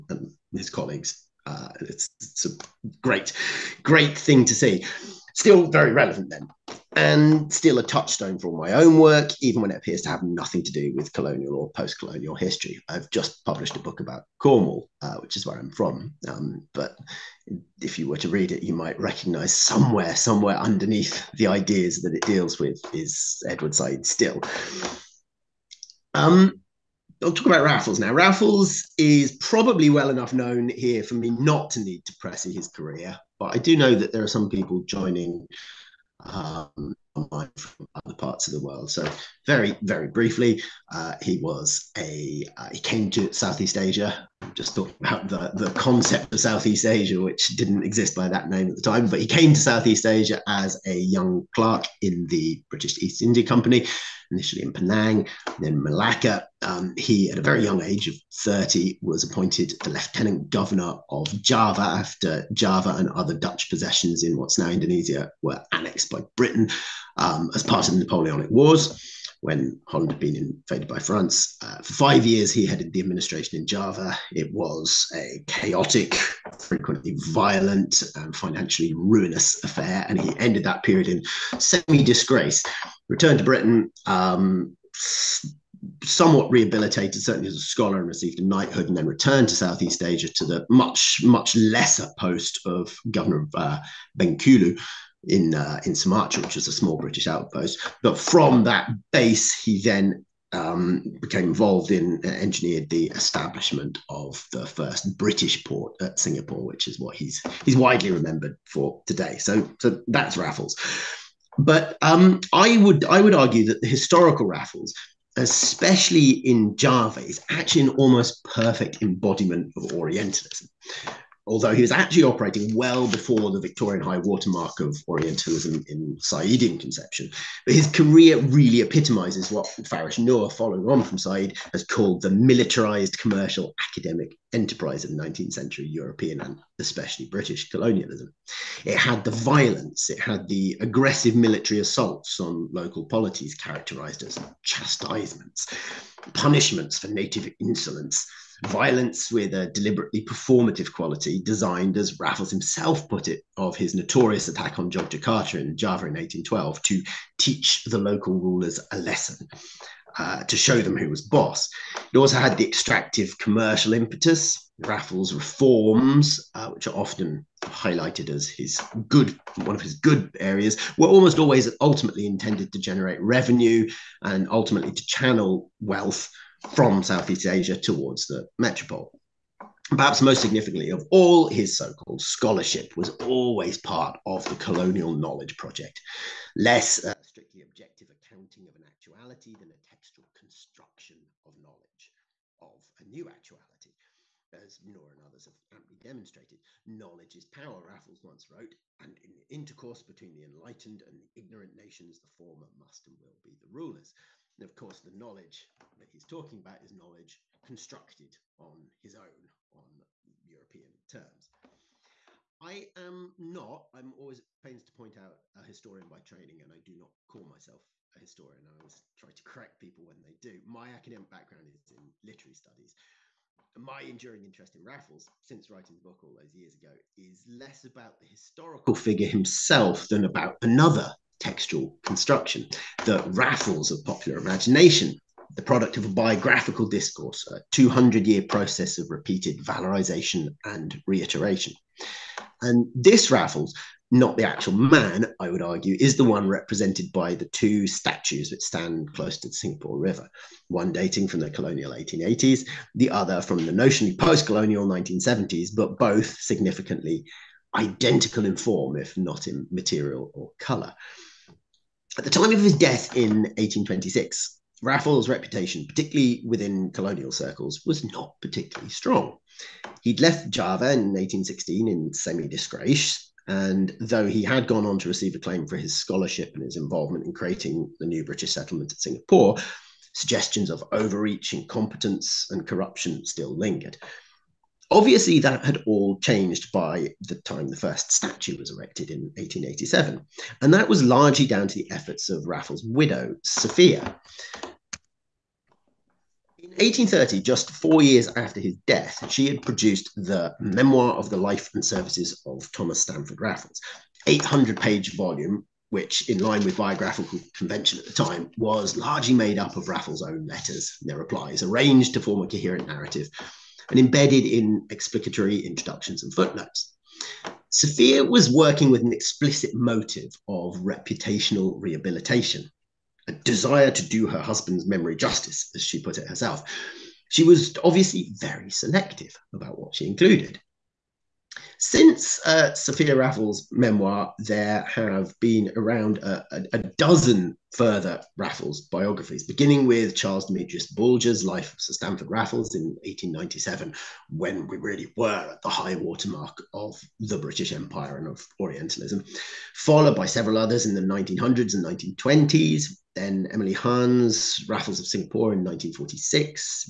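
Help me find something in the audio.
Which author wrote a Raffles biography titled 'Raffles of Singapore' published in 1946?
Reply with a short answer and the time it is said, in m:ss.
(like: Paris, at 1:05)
Emily Hahn, at 5:53.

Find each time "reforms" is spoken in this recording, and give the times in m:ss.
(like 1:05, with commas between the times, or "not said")
2:45.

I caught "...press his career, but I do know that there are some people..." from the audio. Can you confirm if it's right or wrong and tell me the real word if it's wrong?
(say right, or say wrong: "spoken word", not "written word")
right.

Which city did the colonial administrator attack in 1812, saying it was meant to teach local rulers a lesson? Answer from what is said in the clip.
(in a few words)
Jogjakarta.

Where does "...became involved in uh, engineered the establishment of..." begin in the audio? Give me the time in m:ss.
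1:41.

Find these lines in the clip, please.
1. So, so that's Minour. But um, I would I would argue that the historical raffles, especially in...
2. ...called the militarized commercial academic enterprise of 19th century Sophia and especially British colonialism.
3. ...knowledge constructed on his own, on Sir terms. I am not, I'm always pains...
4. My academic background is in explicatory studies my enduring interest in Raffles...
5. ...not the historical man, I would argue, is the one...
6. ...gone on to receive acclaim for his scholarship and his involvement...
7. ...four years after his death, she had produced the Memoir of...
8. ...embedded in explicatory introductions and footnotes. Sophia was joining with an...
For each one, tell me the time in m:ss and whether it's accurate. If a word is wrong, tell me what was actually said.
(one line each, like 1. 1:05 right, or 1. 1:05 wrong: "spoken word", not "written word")
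1. 1:49 wrong: "Raffles", not "Minour"
2. 2:11 wrong: "European", not "Sophia"
3. 3:26 wrong: "European", not "Sir"
4. 3:40 wrong: "literary", not "explicatory"
5. 4:04 wrong: "actual", not "historical"
6. 4:34 right
7. 4:57 right
8. 5:13 wrong: "working", not "joining".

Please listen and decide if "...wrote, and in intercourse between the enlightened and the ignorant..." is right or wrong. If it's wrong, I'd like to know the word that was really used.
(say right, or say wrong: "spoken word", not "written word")
right.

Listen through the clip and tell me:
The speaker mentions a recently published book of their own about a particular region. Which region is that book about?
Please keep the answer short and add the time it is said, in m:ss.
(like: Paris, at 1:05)
Cornwall, at 0:14.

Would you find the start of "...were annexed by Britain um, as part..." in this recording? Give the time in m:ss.
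1:05.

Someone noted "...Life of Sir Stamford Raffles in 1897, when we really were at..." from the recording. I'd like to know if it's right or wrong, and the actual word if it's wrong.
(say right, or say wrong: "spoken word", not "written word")
right.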